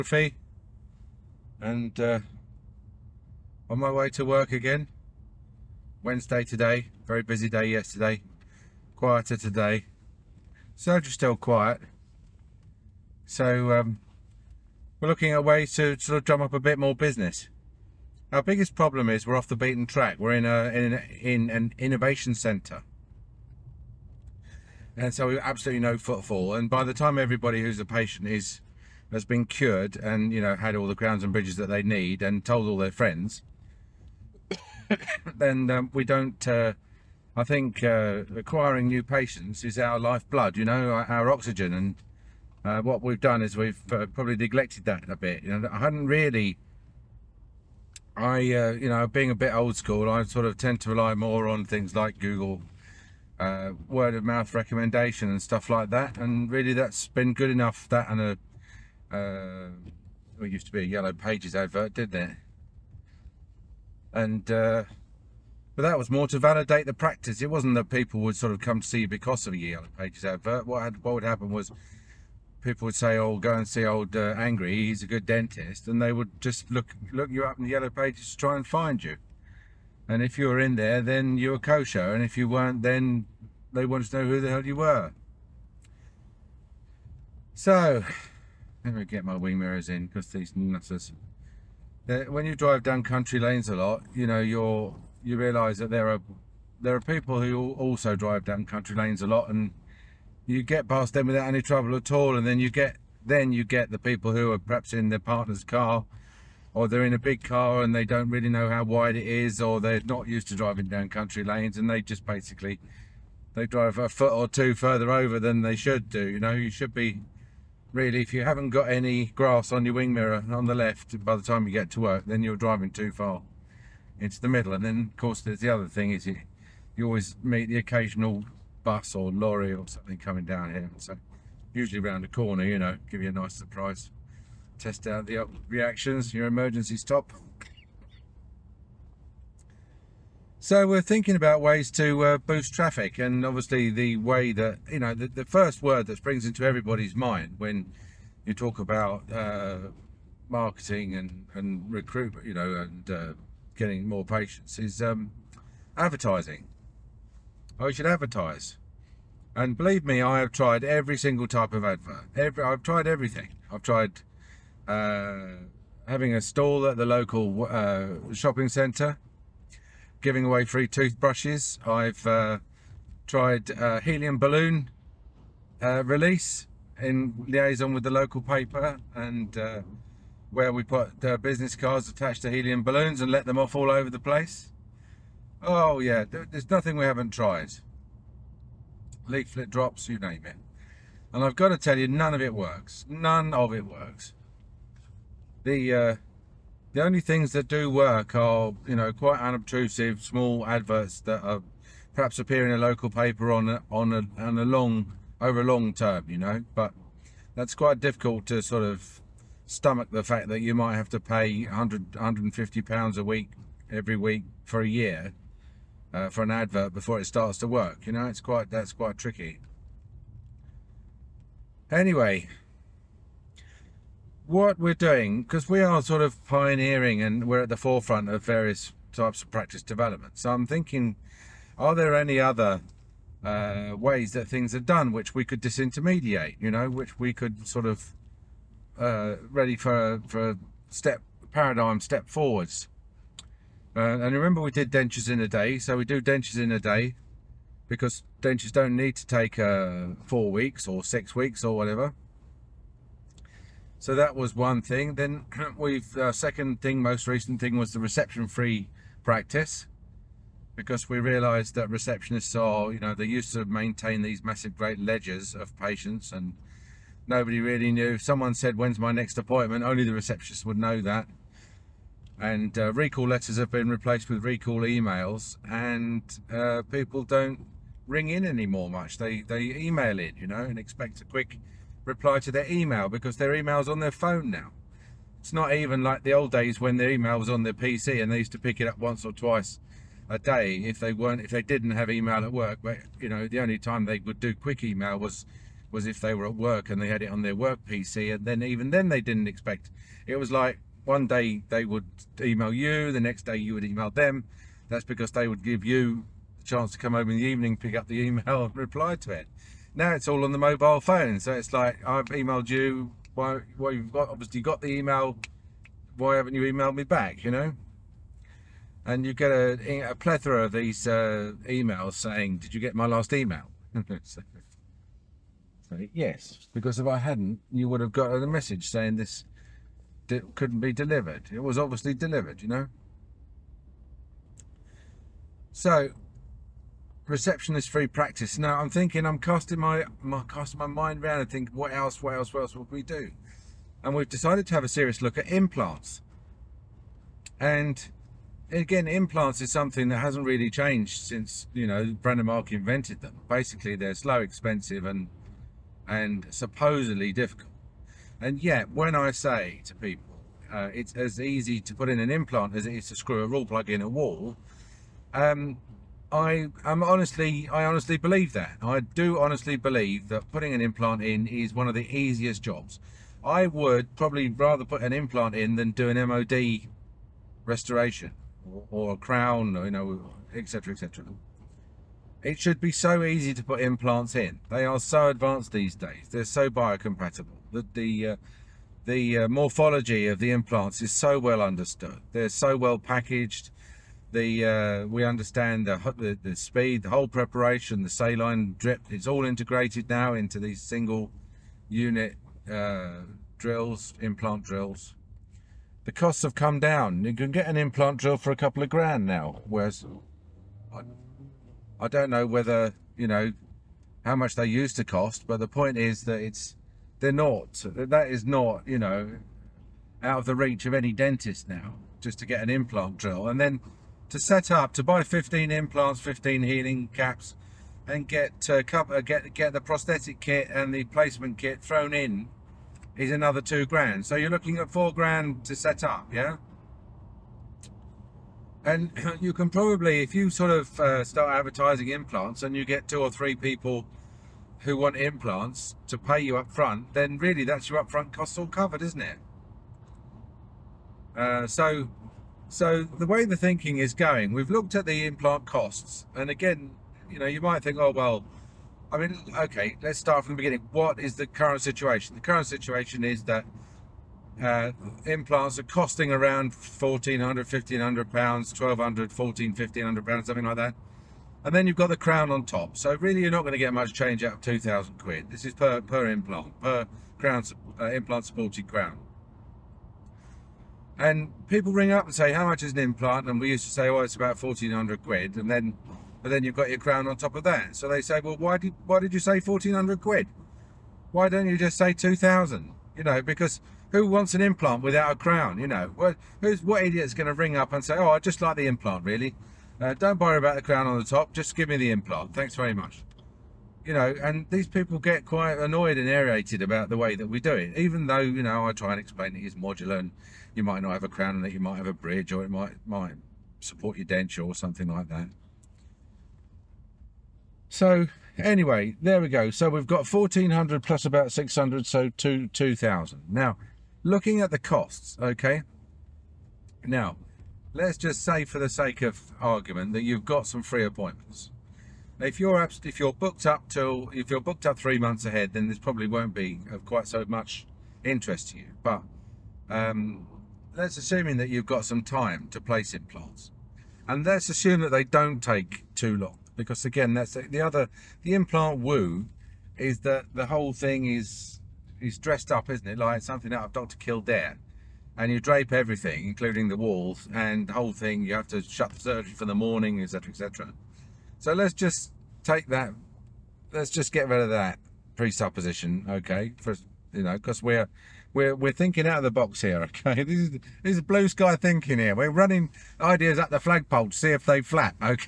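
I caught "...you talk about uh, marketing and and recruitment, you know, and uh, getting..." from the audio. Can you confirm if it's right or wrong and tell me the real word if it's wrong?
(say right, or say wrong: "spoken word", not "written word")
right.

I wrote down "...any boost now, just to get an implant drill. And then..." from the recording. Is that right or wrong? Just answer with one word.
wrong.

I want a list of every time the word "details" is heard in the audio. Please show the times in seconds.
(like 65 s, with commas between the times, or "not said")
not said.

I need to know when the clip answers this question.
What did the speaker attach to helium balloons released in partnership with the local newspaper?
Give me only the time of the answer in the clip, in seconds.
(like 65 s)
181 s.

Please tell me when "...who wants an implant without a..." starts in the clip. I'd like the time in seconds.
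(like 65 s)
494 s.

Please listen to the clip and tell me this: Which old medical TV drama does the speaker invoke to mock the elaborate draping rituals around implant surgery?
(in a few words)
Dr. Kildare.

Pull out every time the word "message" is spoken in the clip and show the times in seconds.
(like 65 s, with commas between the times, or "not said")
328 s.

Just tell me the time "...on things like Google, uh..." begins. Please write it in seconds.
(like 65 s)
51 s.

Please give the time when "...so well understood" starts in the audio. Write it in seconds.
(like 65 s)
391 s.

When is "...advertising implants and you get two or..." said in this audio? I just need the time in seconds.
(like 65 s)
441 s.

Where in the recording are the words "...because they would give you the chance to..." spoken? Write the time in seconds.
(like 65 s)
305 s.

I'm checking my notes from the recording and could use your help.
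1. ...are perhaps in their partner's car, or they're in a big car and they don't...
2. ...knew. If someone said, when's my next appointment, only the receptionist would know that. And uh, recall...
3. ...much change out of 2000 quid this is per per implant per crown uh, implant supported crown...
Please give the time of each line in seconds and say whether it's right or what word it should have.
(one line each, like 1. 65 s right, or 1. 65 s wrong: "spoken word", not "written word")
1. 104 s right
2. 267 s right
3. 473 s right.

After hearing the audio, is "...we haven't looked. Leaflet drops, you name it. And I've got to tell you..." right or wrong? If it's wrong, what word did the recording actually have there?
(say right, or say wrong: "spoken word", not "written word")
wrong: "tried", not "looked".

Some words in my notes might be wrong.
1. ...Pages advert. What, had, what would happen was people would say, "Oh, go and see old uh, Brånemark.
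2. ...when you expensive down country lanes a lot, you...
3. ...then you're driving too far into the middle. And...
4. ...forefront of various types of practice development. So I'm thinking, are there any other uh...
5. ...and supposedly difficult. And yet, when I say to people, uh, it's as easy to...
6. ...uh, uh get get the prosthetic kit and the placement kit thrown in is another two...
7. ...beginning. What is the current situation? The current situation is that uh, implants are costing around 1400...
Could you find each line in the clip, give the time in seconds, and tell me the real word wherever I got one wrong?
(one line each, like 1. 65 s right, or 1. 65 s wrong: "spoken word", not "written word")
1. 69 s wrong: "Angry", not "Brånemark"
2. 92 s wrong: "drive", not "expensive"
3. 122 s right
4. 227 s right
5. 356 s right
6. 428 s right
7. 460 s right.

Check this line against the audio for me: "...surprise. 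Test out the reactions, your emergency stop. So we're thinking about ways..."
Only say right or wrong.
right.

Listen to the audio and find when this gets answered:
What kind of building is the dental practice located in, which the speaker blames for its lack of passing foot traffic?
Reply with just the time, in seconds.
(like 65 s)
21 s.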